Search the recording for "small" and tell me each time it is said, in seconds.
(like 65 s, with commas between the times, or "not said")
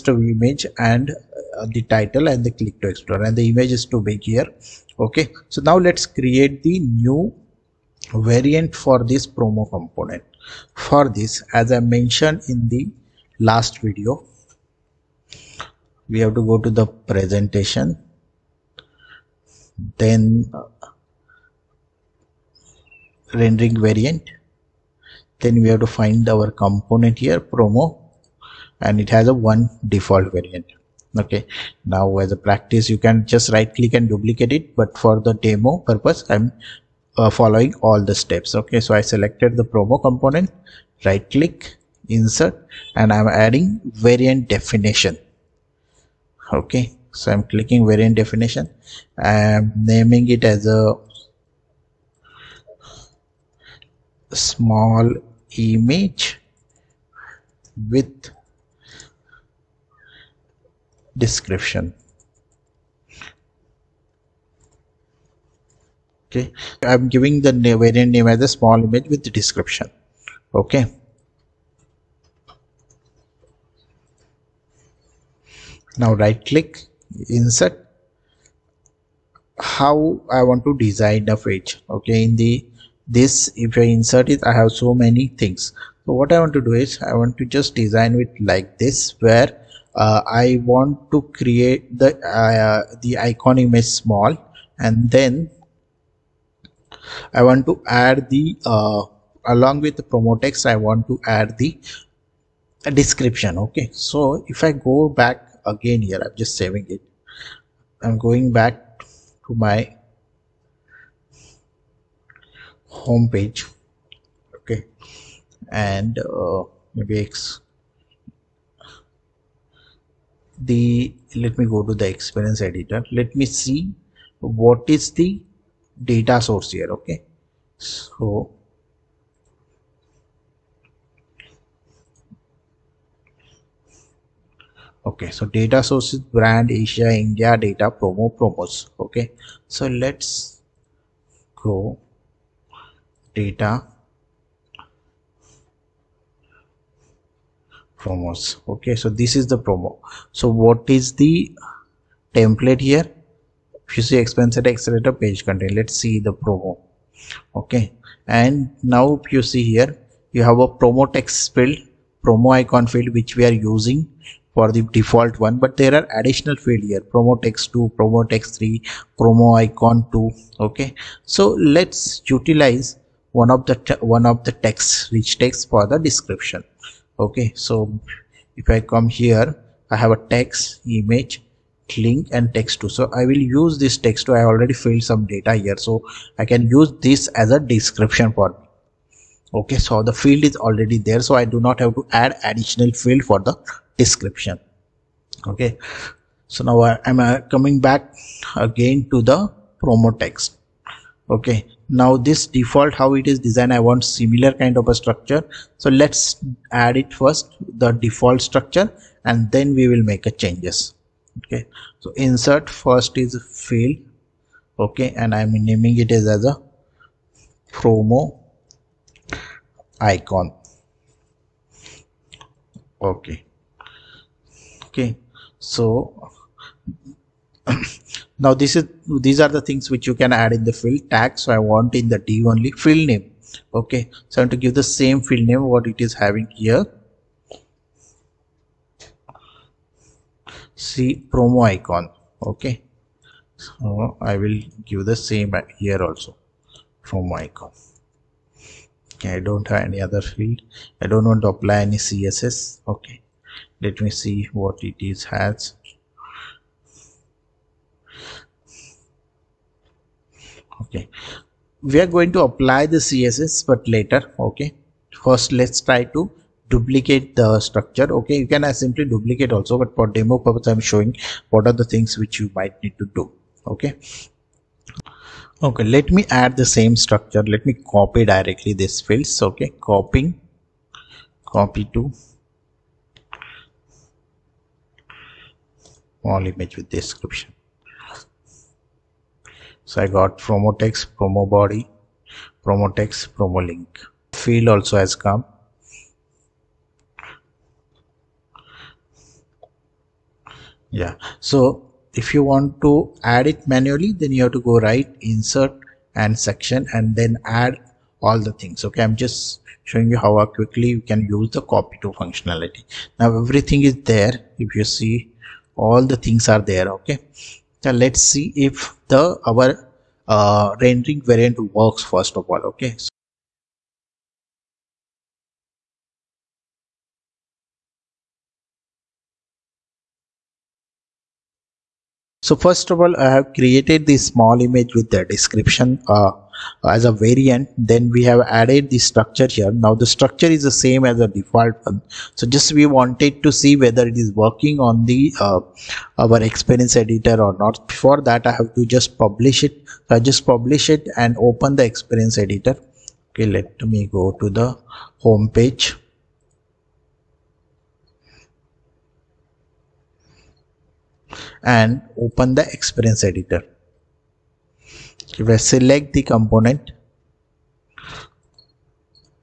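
54 s, 68 s, 93 s, 334 s.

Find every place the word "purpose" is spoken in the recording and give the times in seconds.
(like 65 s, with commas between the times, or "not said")
35 s, 270 s.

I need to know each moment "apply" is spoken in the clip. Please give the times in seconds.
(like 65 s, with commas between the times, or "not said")
251 s, 262 s.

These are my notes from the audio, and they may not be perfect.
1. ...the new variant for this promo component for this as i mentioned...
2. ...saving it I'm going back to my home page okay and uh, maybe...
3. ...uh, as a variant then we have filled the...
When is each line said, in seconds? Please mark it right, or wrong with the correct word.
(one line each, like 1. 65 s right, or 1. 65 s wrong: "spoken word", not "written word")
1. 6 s right
2. 106 s right
3. 336 s wrong: "added", not "filled".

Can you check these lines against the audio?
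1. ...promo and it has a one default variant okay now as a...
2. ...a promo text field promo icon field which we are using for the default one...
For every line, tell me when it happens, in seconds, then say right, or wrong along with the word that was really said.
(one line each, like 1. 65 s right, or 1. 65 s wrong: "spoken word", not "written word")
1. 27 s right
2. 160 s right.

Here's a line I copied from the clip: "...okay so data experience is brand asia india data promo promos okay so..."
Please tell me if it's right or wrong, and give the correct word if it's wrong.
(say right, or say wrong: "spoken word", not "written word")
wrong: "source", not "experience".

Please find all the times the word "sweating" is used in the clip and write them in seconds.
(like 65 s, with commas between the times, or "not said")
not said.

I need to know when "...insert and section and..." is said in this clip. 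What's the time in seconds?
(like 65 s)
305 s.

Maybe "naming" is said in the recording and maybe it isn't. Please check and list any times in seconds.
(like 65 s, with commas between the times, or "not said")
49 s, 215 s.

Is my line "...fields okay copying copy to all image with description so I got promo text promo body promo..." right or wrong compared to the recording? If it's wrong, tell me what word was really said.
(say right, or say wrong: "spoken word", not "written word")
right.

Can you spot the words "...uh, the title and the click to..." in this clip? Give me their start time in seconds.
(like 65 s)
1 s.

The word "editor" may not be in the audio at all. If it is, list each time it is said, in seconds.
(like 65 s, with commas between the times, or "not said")
122 s, 347 s, 352 s, 363 s.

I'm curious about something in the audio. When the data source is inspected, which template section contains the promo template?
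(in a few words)
Experience Accelerator page content.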